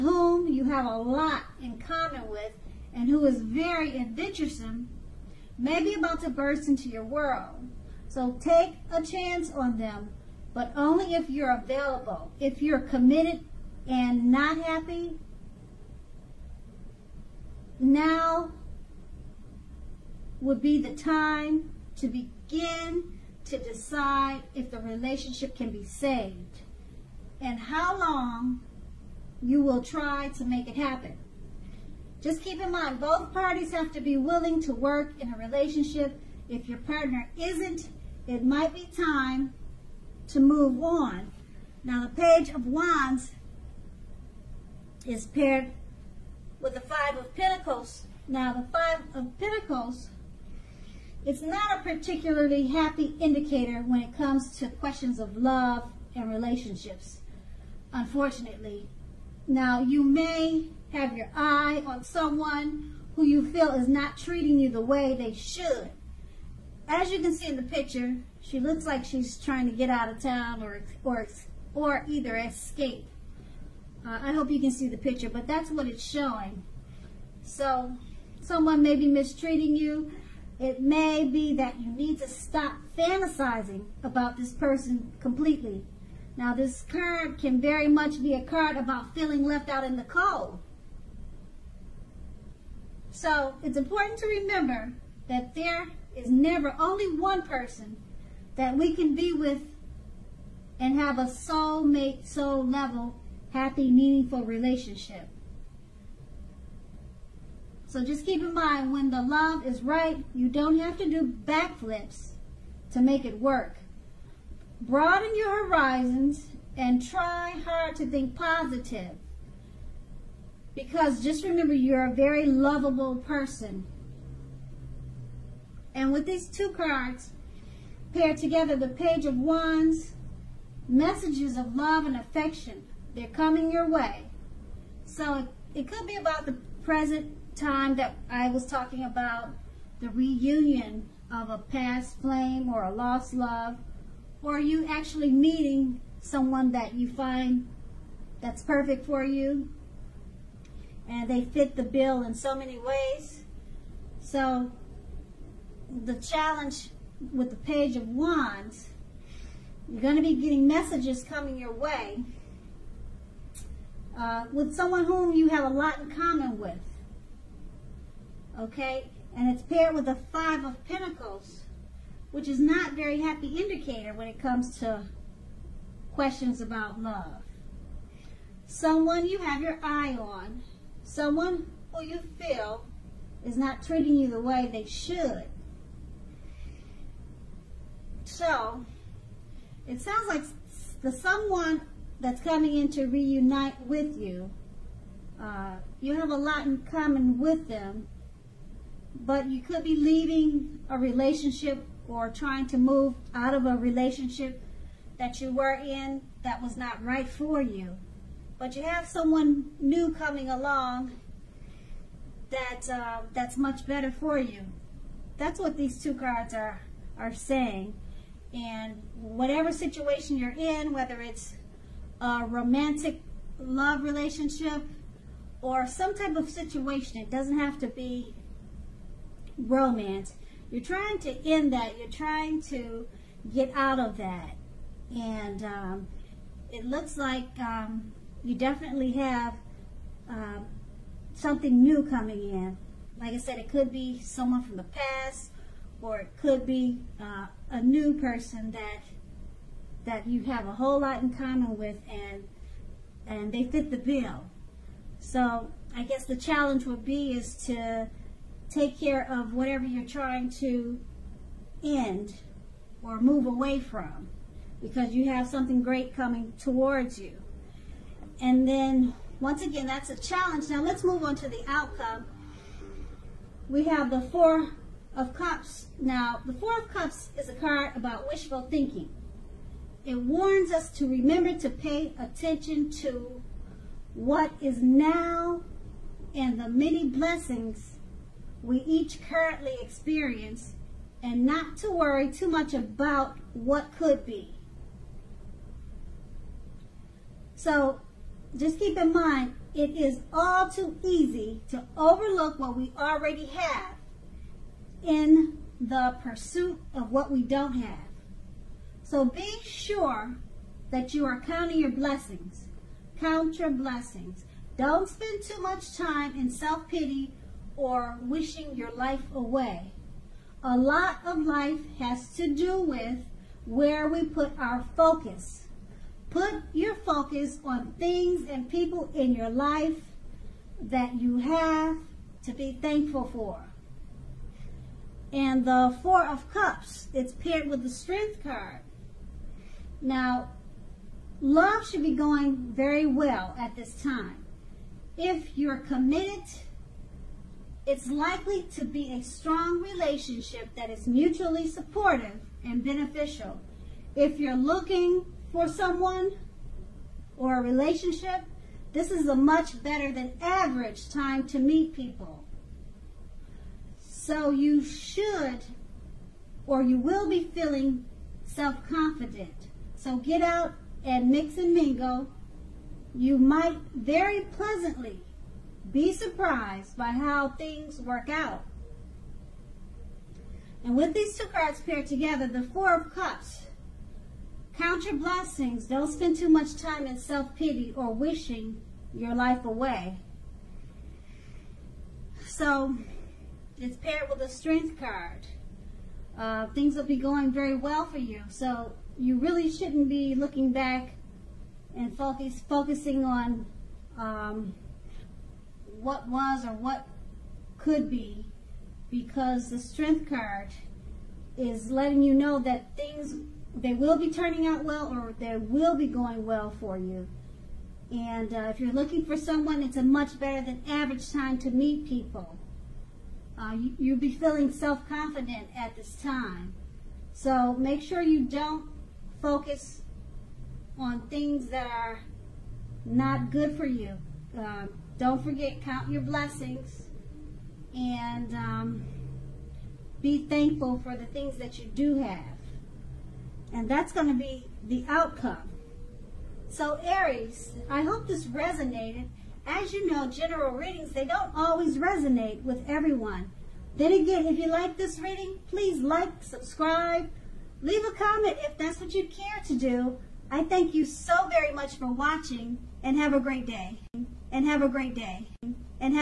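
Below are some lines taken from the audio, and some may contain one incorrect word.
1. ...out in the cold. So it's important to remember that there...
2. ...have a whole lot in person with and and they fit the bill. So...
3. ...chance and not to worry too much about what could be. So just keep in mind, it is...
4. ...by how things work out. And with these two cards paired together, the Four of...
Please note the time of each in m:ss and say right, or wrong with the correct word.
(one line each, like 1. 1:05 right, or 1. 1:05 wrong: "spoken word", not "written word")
1. 1:29 right
2. 4:10 wrong: "common", not "person"
3. 4:49 wrong: "experience", not "chance"
4. 6:16 right.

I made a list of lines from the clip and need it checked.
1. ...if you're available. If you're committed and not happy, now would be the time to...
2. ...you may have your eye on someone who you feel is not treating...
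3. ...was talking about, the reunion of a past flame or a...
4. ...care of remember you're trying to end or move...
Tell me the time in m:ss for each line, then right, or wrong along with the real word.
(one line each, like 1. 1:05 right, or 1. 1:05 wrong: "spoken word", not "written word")
1. 0:11 right
2. 0:59 right
3. 2:18 right
4. 4:18 wrong: "whatever", not "remember".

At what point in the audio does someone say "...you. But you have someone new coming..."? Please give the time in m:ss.
3:27.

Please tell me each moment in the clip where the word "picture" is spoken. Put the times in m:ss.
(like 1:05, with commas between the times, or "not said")
1:07, 1:14.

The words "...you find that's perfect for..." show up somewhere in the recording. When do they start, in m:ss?
2:26.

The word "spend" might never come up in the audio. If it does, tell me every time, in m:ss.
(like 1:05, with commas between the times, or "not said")
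5:15, 6:26.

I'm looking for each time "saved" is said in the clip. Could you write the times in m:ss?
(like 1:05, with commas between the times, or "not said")
0:25.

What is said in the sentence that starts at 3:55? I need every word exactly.
And um, it looks like um, you definitely have um, something new coming in.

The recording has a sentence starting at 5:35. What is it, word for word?
And the Four of Cups, it's paired with the Strength card.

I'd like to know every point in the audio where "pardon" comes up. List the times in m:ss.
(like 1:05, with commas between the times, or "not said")
not said.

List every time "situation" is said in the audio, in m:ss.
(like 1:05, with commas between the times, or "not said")
3:39, 3:46.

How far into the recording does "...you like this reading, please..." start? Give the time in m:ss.
7:34.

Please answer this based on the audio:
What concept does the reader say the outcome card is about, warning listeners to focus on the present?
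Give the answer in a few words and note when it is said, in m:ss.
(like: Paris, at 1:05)
Wishful thinking, at 4:38.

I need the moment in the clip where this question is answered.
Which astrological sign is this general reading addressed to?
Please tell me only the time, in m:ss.
7:27.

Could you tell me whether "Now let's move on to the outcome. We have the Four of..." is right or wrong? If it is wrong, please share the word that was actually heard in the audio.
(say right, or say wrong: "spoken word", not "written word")
right.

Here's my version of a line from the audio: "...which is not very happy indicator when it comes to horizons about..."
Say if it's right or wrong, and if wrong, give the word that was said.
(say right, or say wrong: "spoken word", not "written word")
wrong: "questions", not "horizons".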